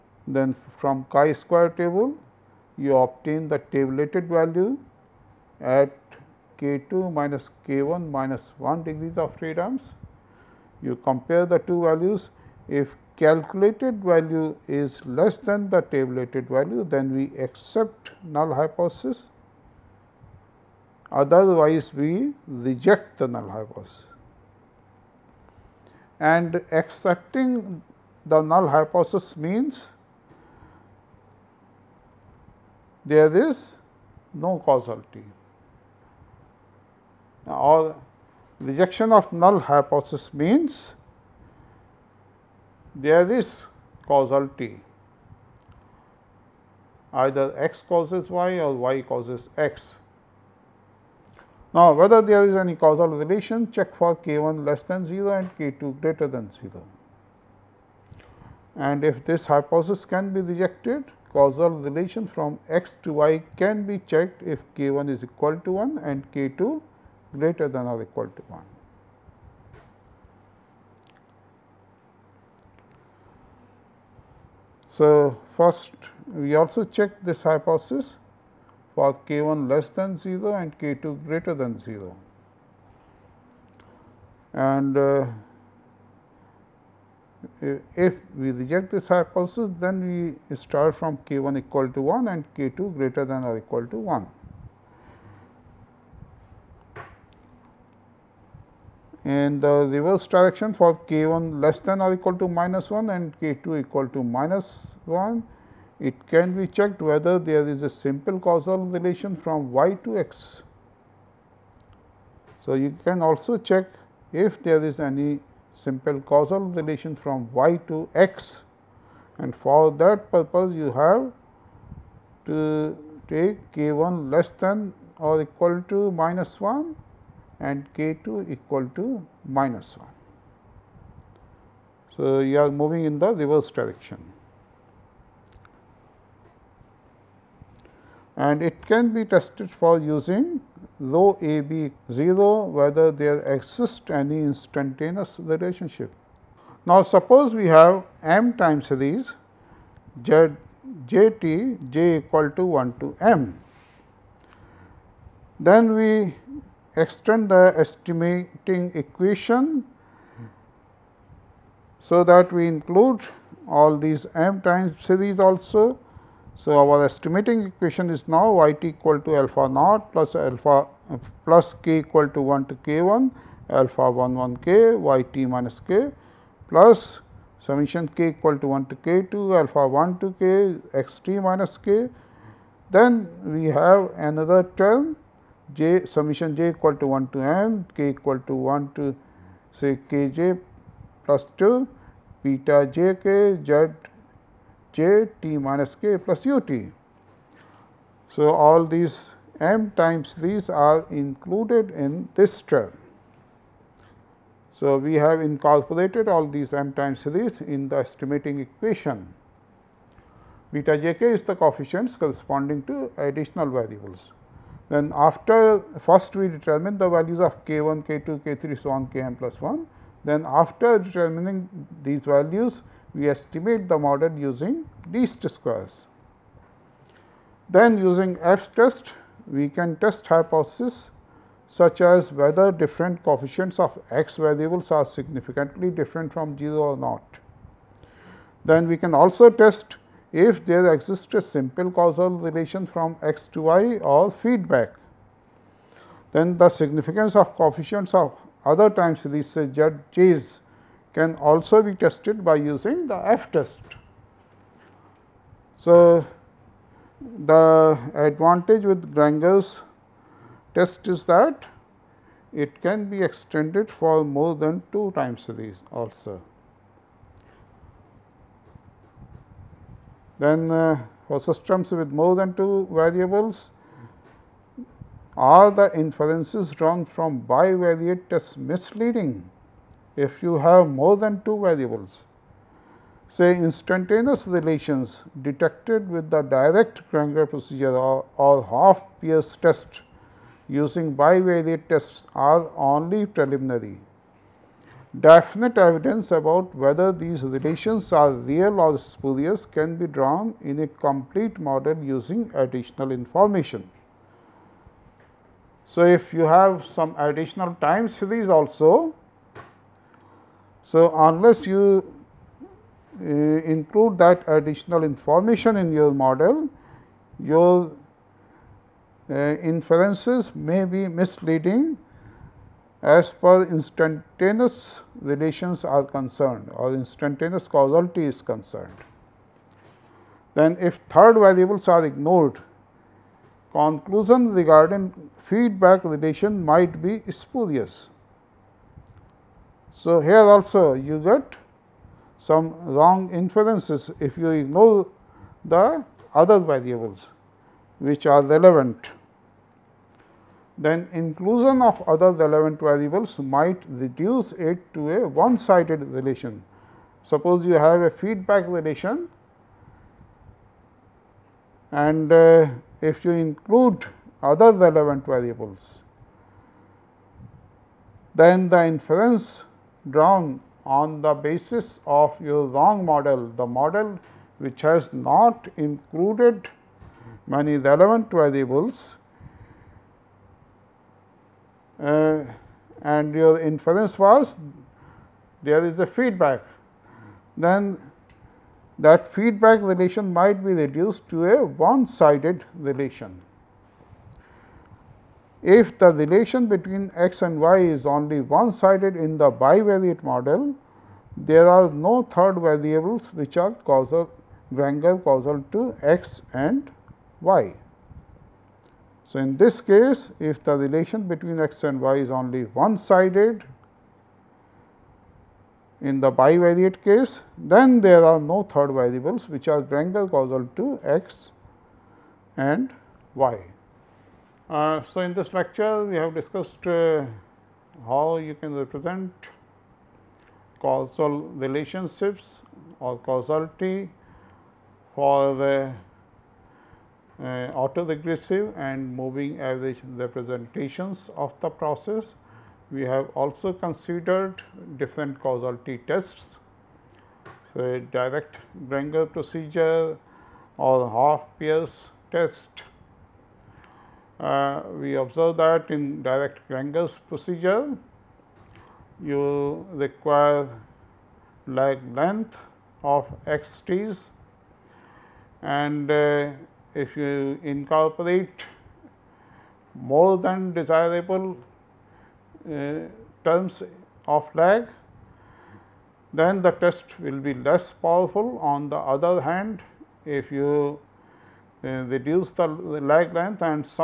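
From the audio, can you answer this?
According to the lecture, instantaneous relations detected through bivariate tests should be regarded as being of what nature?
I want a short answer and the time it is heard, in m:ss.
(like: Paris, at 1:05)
preliminary, at 4:52.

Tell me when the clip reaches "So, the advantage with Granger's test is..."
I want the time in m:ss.
4:15.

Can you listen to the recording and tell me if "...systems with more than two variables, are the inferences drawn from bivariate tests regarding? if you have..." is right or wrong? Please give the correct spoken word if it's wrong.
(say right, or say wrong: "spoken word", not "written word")
wrong: "misleading", not "regarding".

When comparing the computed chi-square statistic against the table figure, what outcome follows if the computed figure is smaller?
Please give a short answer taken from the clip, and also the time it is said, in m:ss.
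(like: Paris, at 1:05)
accept null hypothesis, at 0:17.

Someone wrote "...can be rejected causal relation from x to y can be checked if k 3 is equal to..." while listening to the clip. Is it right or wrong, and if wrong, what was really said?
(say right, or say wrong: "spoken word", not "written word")
wrong: "1", not "3".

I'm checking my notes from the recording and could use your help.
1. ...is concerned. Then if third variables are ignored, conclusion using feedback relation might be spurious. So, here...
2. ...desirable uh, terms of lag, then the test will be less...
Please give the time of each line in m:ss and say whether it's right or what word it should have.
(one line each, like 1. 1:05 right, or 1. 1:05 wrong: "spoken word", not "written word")
1. 5:28 wrong: "regarding", not "using"
2. 7:50 right.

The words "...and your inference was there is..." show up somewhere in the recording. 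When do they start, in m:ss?
6:23.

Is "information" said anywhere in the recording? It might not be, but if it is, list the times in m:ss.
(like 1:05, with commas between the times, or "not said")
5:03, 5:15.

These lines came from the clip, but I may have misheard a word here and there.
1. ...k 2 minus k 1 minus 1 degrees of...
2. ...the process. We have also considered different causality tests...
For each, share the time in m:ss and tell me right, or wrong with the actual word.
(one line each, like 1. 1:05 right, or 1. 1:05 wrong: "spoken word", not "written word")
1. 0:06 right
2. 7:21 right.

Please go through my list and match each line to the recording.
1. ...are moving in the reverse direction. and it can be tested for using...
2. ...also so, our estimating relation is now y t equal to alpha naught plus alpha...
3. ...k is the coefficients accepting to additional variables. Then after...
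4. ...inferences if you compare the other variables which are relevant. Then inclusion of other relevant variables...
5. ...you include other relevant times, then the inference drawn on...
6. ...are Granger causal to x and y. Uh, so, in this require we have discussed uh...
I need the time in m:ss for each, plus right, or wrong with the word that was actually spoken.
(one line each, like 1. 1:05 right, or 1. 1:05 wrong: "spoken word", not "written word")
1. 2:12 right
2. 2:45 wrong: "equation", not "relation"
3. 3:31 wrong: "corresponding", not "accepting"
4. 5:43 wrong: "ignore", not "compare"
5. 6:03 wrong: "variables", not "times"
6. 6:59 wrong: "lecture", not "require".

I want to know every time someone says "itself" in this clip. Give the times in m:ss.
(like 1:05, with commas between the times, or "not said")
not said.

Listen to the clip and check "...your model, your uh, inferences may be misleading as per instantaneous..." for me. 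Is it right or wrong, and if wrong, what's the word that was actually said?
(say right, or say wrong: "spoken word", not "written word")
right.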